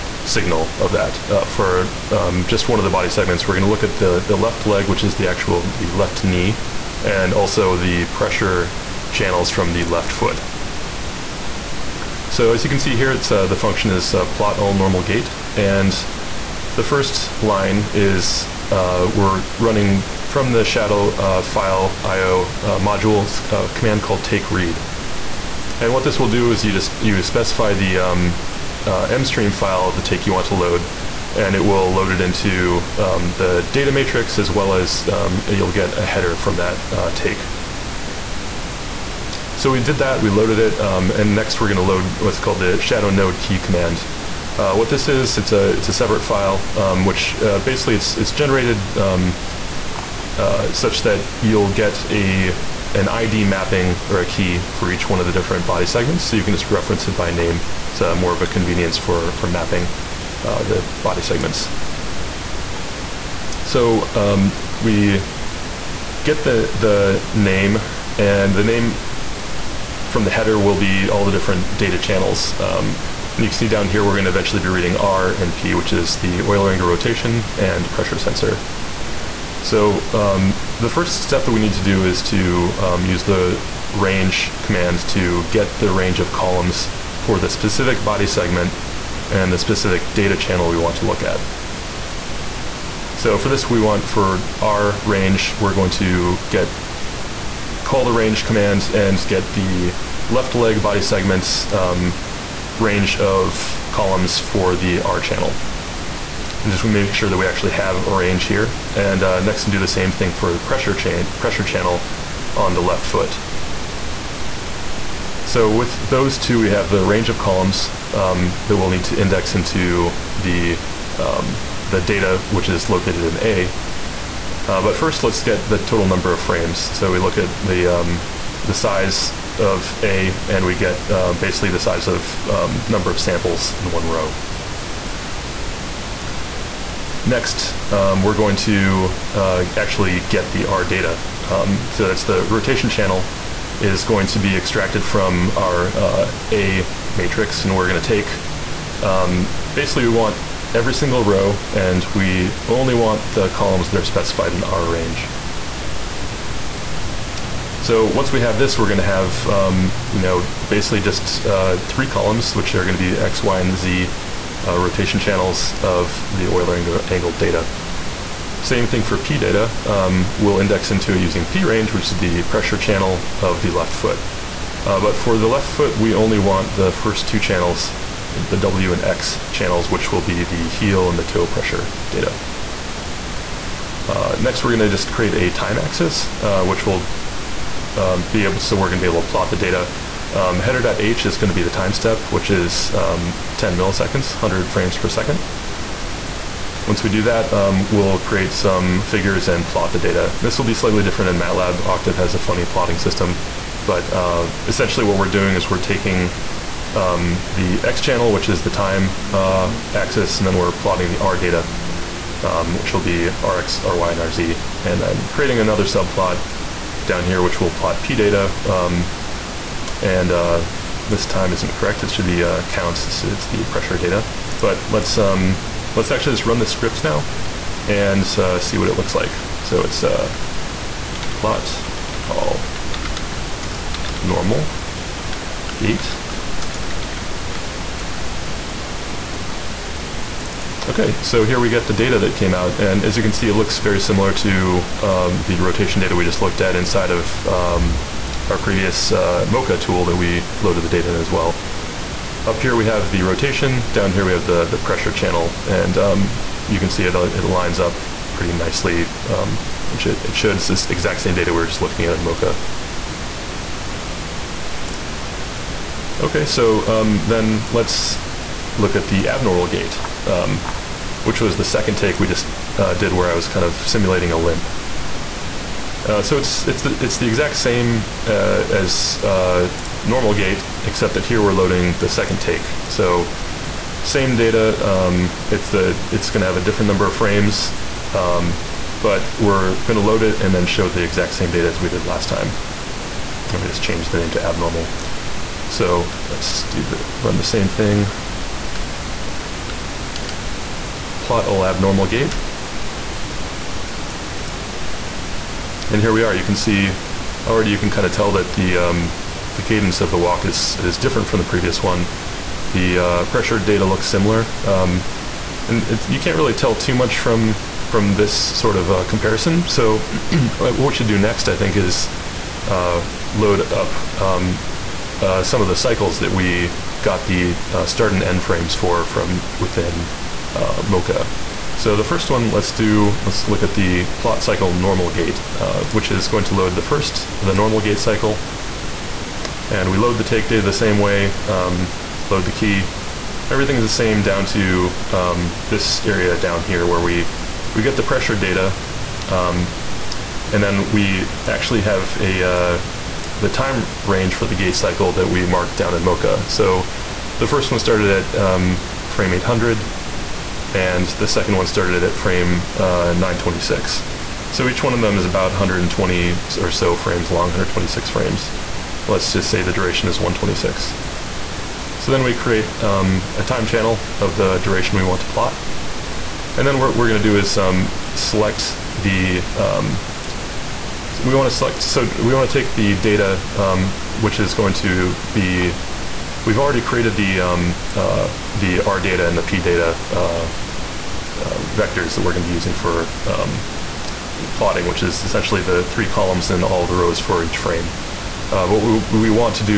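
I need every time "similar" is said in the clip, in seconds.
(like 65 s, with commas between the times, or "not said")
244 s, 314 s.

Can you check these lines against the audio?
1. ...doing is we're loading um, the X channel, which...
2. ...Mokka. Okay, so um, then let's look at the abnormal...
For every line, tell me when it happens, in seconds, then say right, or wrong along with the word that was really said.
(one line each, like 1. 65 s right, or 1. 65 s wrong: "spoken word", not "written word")
1. 205 s wrong: "taking", not "loading"
2. 262 s right.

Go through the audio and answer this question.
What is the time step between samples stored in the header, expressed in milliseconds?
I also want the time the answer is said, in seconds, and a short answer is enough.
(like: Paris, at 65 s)
10 milliseconds, at 193 s.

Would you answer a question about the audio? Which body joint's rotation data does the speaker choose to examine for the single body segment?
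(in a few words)
Left knee.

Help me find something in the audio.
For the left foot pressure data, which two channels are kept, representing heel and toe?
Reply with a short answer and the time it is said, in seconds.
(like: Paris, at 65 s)
W and X, at 178 s.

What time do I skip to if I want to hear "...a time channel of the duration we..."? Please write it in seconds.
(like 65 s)
373 s.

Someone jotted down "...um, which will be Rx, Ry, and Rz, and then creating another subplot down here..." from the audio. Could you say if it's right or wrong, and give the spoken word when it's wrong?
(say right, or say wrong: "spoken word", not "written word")
right.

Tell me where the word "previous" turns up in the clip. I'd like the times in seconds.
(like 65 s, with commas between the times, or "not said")
248 s, 311 s.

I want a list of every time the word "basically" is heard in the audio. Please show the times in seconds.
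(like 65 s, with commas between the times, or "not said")
47 s, 131 s, 149 s, 160 s.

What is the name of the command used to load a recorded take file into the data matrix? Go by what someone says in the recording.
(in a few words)
take read.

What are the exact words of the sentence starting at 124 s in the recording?
Uh, but first, let's get the total number of frames.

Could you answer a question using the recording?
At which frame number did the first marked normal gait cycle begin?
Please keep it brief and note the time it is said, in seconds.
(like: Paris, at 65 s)
800, at 359 s.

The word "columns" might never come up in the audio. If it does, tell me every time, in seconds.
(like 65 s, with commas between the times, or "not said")
86 s, 103 s, 117 s, 153 s, 162 s, 396 s.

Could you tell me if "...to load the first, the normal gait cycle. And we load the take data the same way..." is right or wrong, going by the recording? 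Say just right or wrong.
right.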